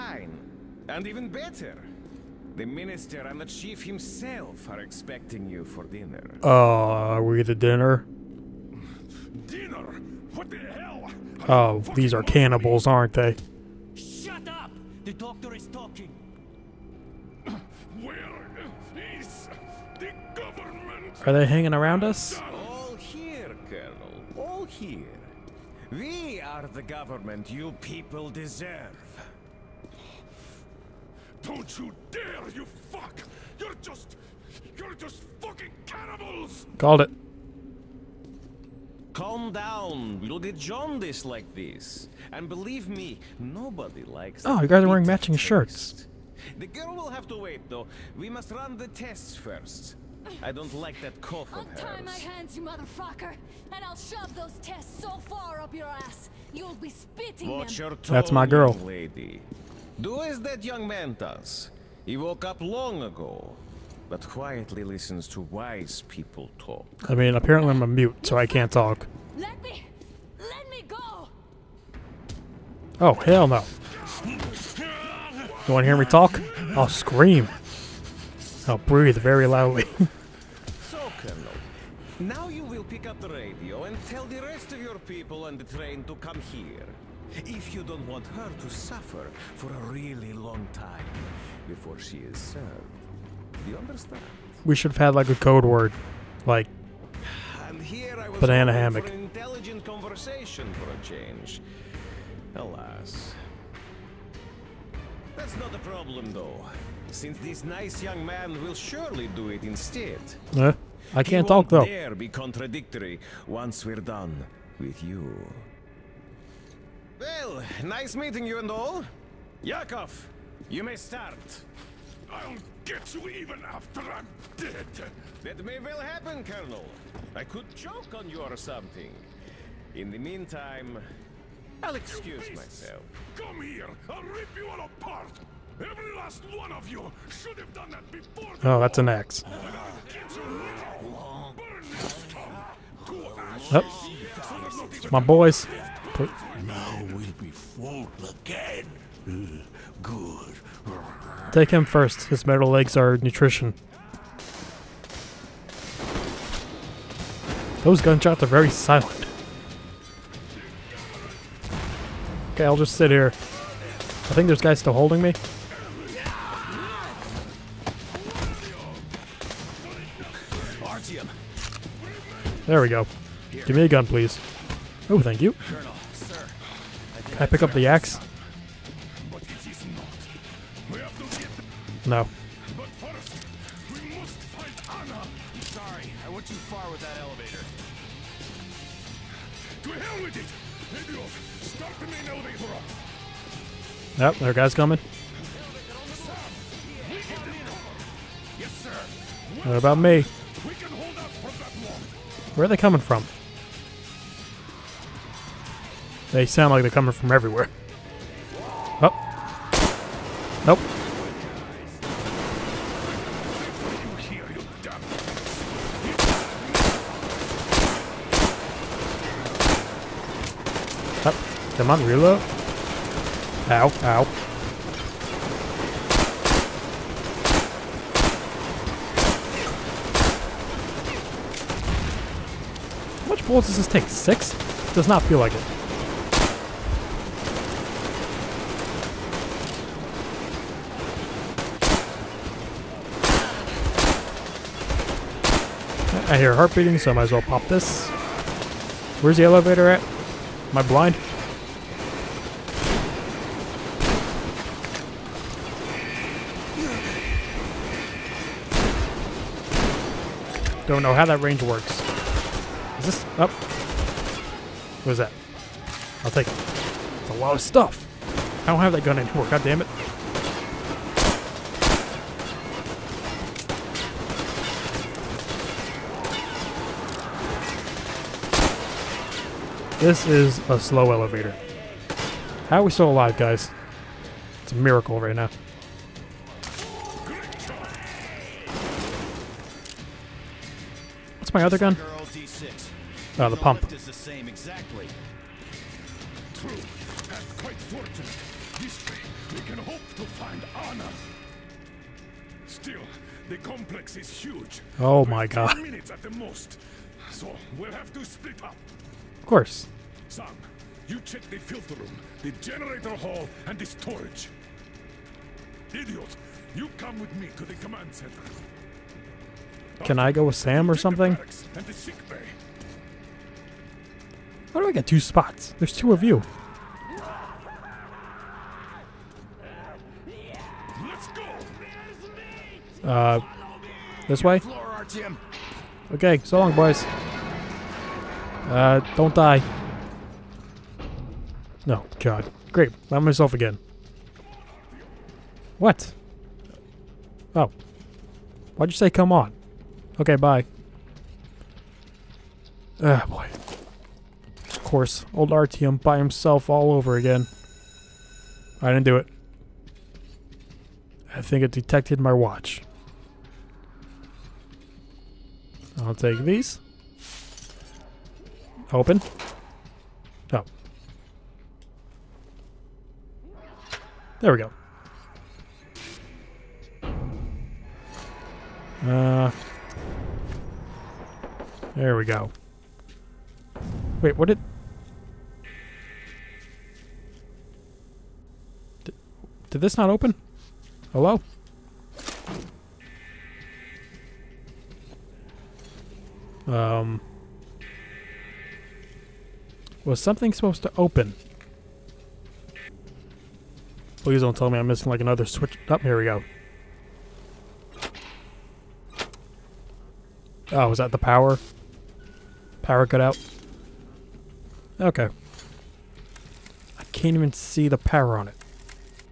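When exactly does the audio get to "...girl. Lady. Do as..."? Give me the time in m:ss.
0:58.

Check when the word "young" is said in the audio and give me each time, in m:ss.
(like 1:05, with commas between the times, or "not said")
1:00, 1:48.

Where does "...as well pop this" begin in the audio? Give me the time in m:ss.
4:07.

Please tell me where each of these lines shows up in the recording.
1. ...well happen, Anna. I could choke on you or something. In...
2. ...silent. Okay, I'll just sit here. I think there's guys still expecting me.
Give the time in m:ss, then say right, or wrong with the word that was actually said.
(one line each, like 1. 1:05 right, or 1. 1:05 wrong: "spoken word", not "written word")
1. 2:05 wrong: "Colonel", not "Anna"
2. 2:38 wrong: "holding", not "expecting".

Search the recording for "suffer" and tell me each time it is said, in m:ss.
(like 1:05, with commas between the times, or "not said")
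1:28.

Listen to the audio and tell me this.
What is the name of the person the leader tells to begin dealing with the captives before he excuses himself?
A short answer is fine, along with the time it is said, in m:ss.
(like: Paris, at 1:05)
Yakov, at 1:59.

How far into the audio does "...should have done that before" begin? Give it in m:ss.
2:17.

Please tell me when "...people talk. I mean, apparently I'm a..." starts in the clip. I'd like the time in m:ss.
1:06.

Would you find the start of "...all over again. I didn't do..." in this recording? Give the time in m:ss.
5:56.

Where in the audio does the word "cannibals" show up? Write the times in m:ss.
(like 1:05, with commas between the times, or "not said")
0:12, 0:35.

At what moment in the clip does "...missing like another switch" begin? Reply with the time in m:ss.
6:44.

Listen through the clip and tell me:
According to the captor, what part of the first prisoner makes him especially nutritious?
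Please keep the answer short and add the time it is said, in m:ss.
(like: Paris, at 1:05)
metal legs, at 2:32.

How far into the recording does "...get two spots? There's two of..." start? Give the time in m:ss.
5:24.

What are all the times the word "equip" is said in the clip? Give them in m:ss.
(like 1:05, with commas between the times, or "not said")
not said.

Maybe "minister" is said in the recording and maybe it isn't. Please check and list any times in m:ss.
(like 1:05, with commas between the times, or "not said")
0:02.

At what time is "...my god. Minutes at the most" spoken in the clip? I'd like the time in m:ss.
5:05.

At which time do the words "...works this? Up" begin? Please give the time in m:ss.
4:21.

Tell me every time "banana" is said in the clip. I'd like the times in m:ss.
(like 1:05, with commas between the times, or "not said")
1:38.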